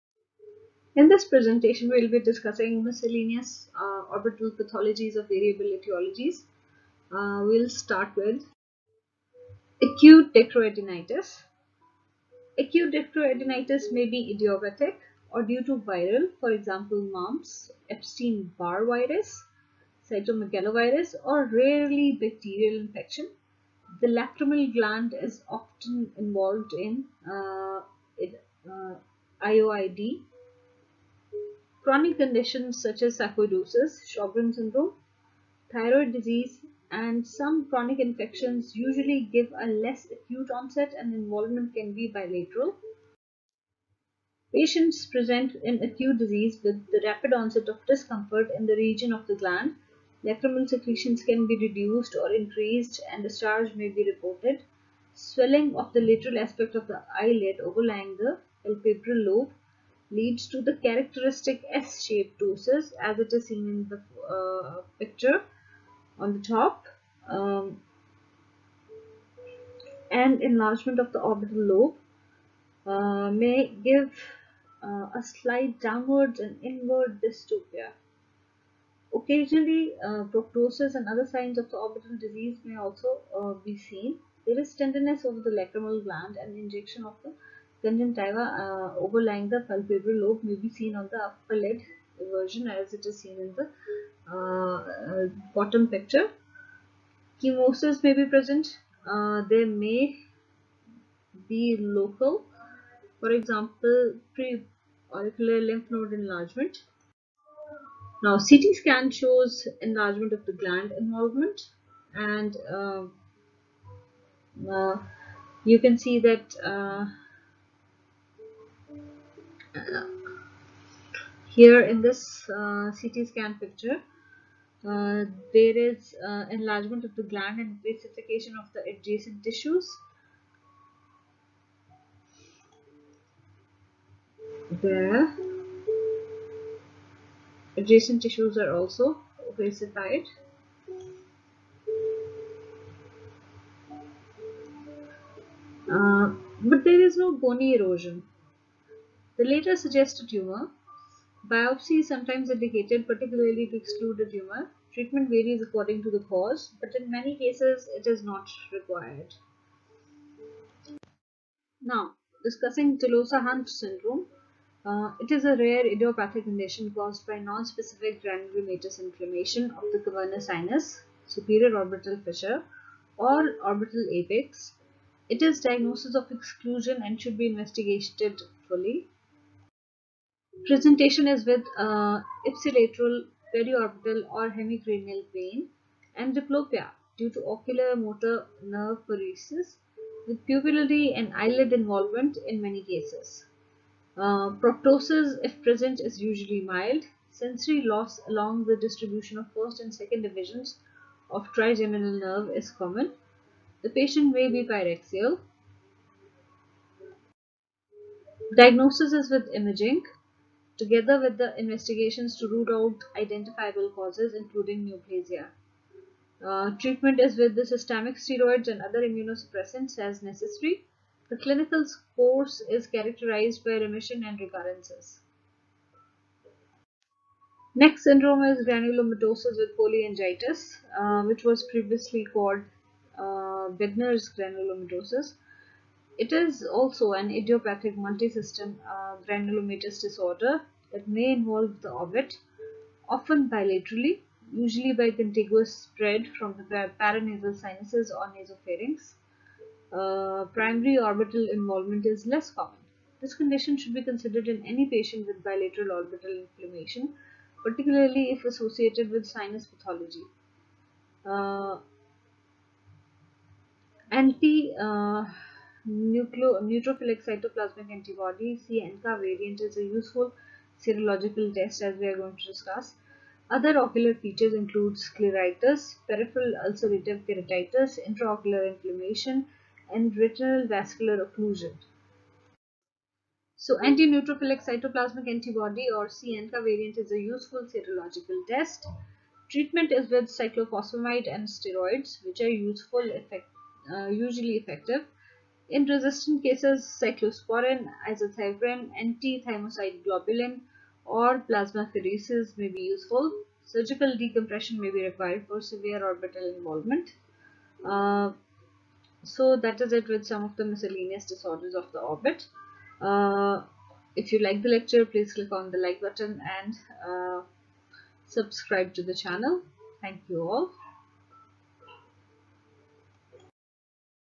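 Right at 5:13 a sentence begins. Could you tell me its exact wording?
Uh, if you like the lecture, please click on the like button and uh, subscribe to the channel.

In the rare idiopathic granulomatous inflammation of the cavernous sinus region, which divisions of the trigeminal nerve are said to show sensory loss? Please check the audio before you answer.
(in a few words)
first and second.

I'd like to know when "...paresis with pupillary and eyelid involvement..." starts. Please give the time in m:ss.
3:09.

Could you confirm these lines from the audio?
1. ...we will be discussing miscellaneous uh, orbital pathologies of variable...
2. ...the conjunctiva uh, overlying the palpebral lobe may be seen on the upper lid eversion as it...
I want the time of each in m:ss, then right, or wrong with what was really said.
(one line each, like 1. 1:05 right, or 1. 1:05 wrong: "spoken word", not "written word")
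1. 0:01 right
2. 1:27 right.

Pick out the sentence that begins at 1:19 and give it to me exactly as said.
Occasionally, uh, proptosis and other signs of the orbital disease may also uh, be seen.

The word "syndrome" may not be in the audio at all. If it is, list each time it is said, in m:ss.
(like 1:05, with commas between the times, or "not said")
0:34, 2:43, 3:48.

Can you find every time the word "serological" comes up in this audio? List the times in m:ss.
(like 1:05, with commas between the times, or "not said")
4:30, 4:47.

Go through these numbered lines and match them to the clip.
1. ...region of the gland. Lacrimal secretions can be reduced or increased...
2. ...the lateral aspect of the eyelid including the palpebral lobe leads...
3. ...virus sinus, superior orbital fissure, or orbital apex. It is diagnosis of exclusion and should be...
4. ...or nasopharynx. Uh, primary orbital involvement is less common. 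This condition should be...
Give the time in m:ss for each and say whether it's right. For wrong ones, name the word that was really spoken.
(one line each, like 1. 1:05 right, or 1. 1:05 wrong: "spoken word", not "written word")
1. 0:48 right
2. 0:55 wrong: "overlying", not "including"
3. 2:50 wrong: "cavernous", not "virus"
4. 4:08 right.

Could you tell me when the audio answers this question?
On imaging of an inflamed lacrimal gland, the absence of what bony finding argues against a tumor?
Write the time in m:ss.
2:27.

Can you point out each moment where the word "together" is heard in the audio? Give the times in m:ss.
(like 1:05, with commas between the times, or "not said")
3:30.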